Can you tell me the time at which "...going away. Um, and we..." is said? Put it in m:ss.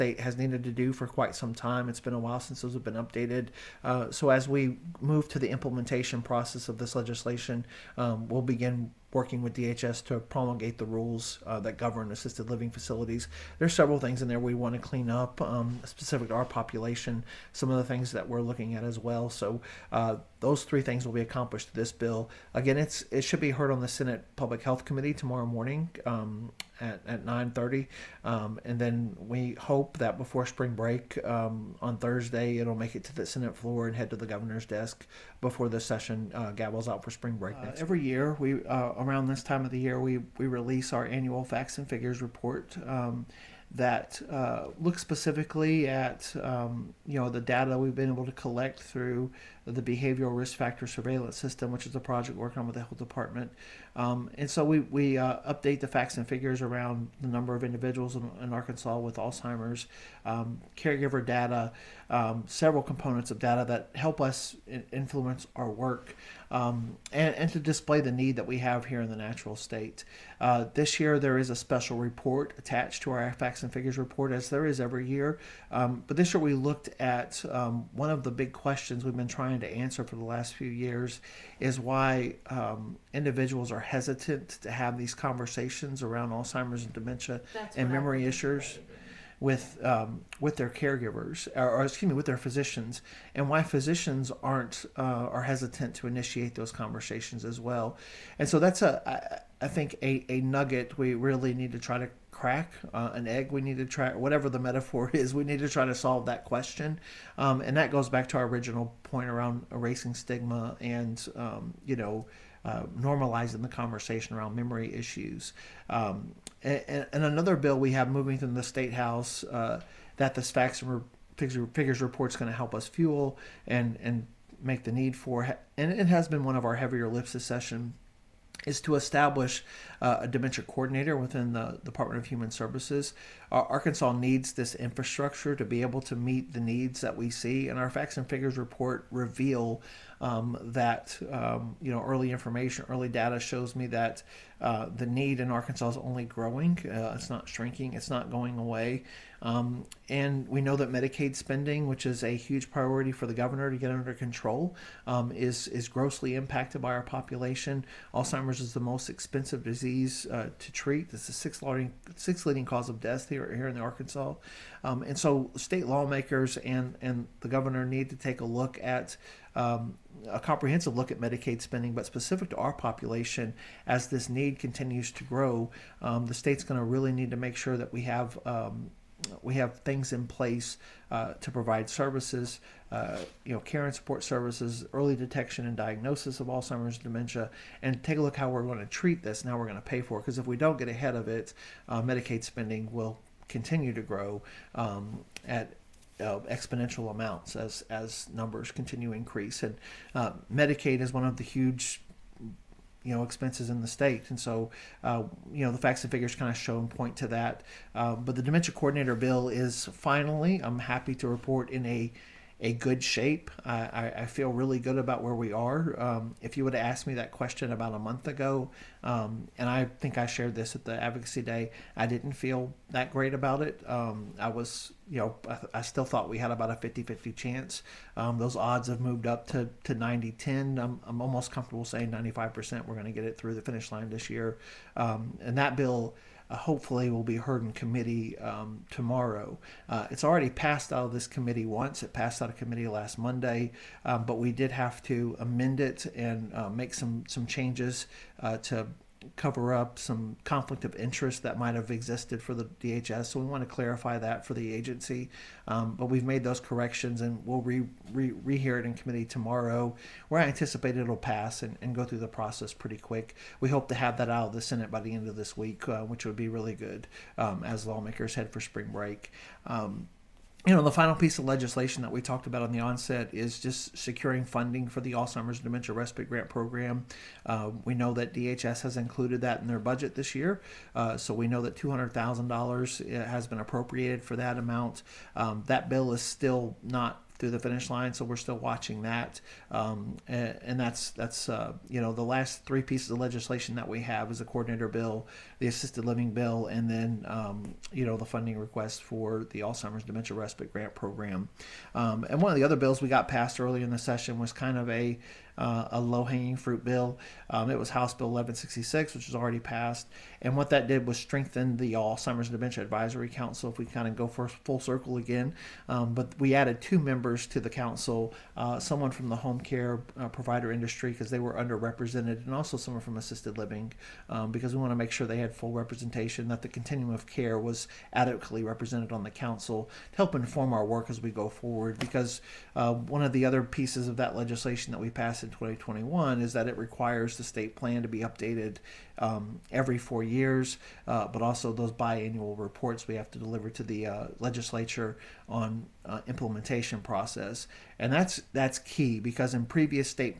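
2:28.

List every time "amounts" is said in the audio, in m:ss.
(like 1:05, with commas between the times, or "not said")
3:17, 4:44.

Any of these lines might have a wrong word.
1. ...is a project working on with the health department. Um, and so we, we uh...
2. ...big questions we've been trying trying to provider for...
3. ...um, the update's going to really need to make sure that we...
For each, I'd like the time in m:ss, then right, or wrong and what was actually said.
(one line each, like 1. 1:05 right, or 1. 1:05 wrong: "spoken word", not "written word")
1. 0:51 right
2. 1:18 wrong: "answer", not "provider"
3. 2:56 wrong: "state", not "update".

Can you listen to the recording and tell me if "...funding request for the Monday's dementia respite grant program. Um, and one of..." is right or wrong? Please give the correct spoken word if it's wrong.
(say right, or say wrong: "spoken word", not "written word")
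wrong: "Alzheimer", not "Monday".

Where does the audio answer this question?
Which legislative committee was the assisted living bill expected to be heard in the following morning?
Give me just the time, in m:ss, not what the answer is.
0:23.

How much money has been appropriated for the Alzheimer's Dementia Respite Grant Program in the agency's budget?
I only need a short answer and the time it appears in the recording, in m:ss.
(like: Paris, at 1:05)
$200,000, at 4:41.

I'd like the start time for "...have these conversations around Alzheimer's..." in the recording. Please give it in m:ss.
1:24.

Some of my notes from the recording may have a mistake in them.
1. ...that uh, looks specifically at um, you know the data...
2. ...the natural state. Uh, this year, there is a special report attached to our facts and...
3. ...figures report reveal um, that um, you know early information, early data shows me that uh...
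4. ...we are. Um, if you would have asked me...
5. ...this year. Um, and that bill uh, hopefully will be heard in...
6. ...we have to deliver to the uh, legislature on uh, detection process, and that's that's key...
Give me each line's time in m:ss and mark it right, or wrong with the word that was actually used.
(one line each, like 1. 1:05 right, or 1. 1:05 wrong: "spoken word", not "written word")
1. 0:43 right
2. 1:09 right
3. 2:18 right
4. 3:35 right
5. 3:54 right
6. 5:43 wrong: "implementation", not "detection".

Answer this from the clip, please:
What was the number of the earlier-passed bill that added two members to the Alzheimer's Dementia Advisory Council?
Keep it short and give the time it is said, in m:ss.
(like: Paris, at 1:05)
House Bill 1166, at 5:07.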